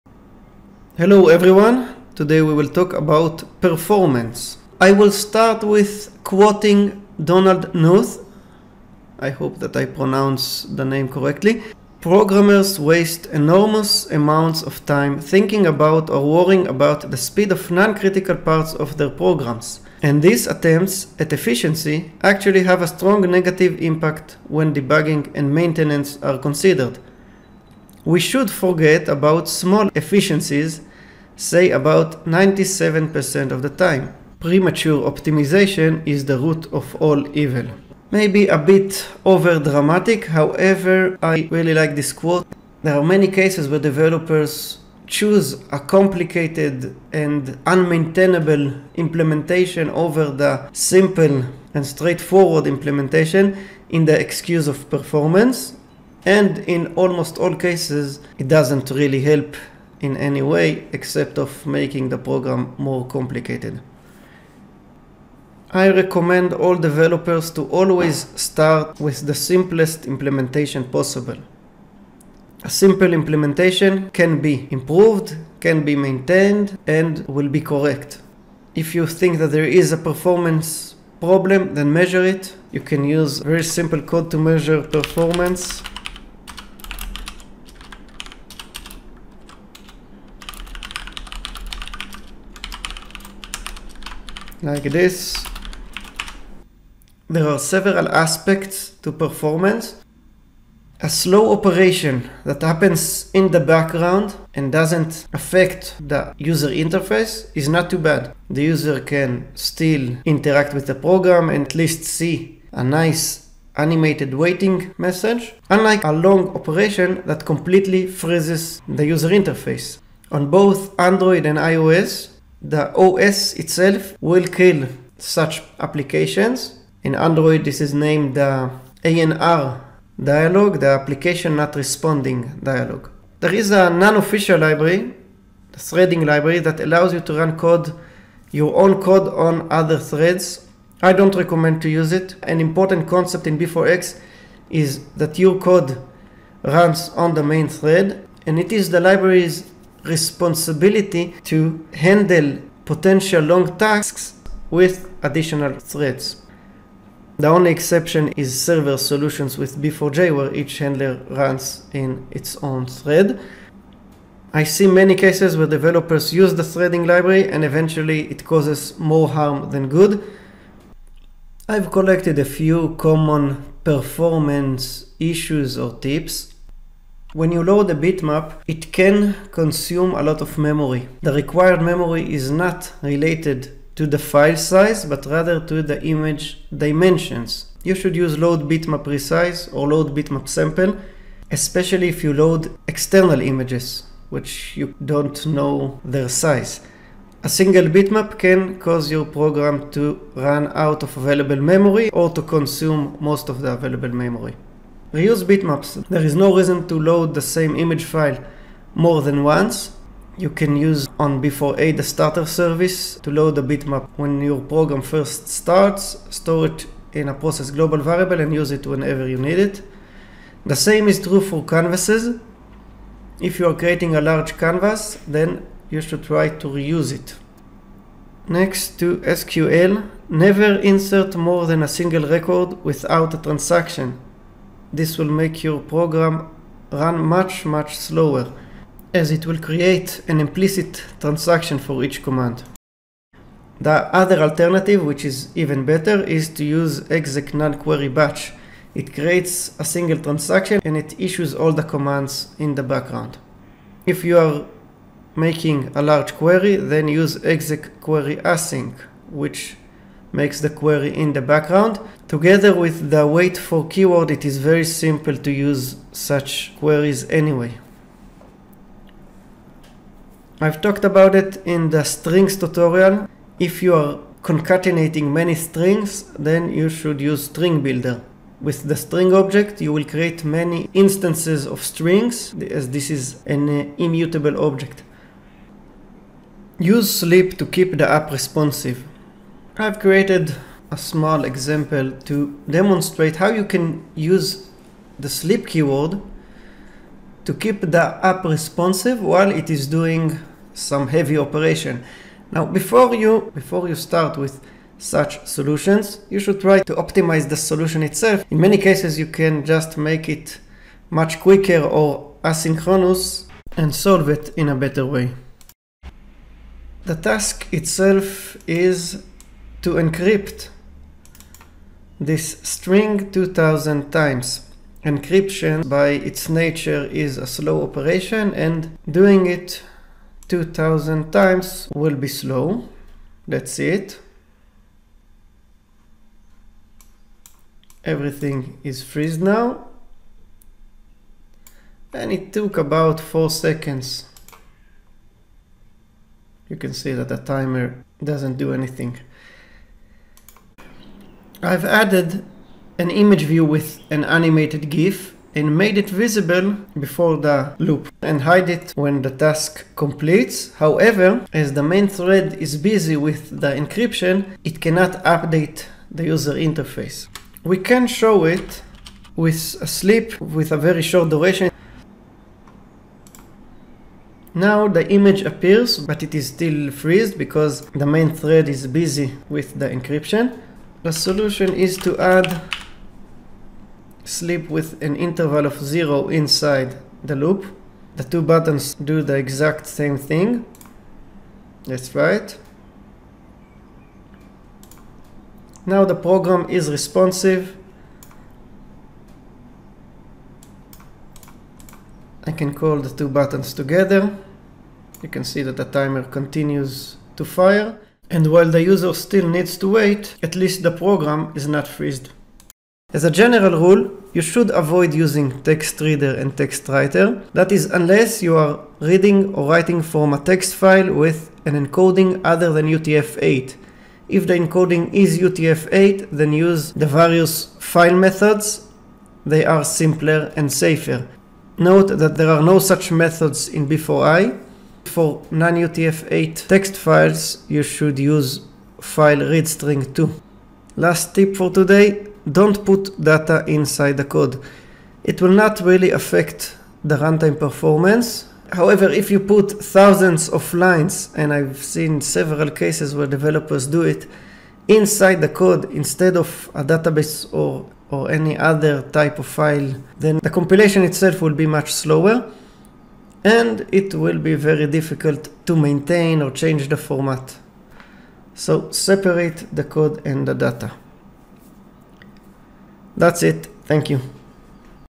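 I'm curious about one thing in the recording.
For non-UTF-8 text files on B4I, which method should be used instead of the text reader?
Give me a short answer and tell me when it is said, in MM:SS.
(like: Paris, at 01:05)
file read string 2, at 07:18.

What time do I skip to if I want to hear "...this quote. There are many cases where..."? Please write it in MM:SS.
00:41.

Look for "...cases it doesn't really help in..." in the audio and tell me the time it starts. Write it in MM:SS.
00:57.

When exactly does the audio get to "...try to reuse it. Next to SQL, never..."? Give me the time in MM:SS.
03:46.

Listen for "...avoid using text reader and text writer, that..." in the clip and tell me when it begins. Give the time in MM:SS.
06:54.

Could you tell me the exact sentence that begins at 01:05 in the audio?
I recommend all developers to always start with the simplest implementation possible.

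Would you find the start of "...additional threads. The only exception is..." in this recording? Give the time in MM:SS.
02:35.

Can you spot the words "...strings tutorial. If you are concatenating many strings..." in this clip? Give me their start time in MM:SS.
04:32.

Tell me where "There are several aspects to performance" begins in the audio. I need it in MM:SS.
01:37.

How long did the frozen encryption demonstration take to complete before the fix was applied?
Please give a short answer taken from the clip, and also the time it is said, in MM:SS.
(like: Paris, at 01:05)
4 seconds, at 05:43.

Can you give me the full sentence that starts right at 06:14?
Now the image appears, but it is still freezed because the main thread is busy with the encryption.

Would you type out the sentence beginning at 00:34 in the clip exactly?
Premature optimization is the root of all evil.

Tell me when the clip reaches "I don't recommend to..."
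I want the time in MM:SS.
02:21.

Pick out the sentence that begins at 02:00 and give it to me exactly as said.
On both Android and iOS, the OS itself will kill such applications.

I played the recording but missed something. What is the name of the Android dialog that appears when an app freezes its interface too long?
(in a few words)
ANR dialog.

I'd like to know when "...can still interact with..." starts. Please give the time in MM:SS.
01:48.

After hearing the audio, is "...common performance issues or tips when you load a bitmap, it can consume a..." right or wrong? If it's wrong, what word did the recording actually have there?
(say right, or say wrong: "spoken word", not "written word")
right.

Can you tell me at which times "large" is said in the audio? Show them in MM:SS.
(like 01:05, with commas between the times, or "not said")
03:44, 04:16.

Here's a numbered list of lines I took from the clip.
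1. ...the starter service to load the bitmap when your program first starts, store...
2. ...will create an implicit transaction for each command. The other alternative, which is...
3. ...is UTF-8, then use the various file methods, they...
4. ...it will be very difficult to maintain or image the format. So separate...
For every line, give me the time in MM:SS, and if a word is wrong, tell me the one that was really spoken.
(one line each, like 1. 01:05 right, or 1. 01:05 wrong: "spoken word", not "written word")
1. 03:31 right
2. 03:59 right
3. 07:05 right
4. 07:43 wrong: "change", not "image".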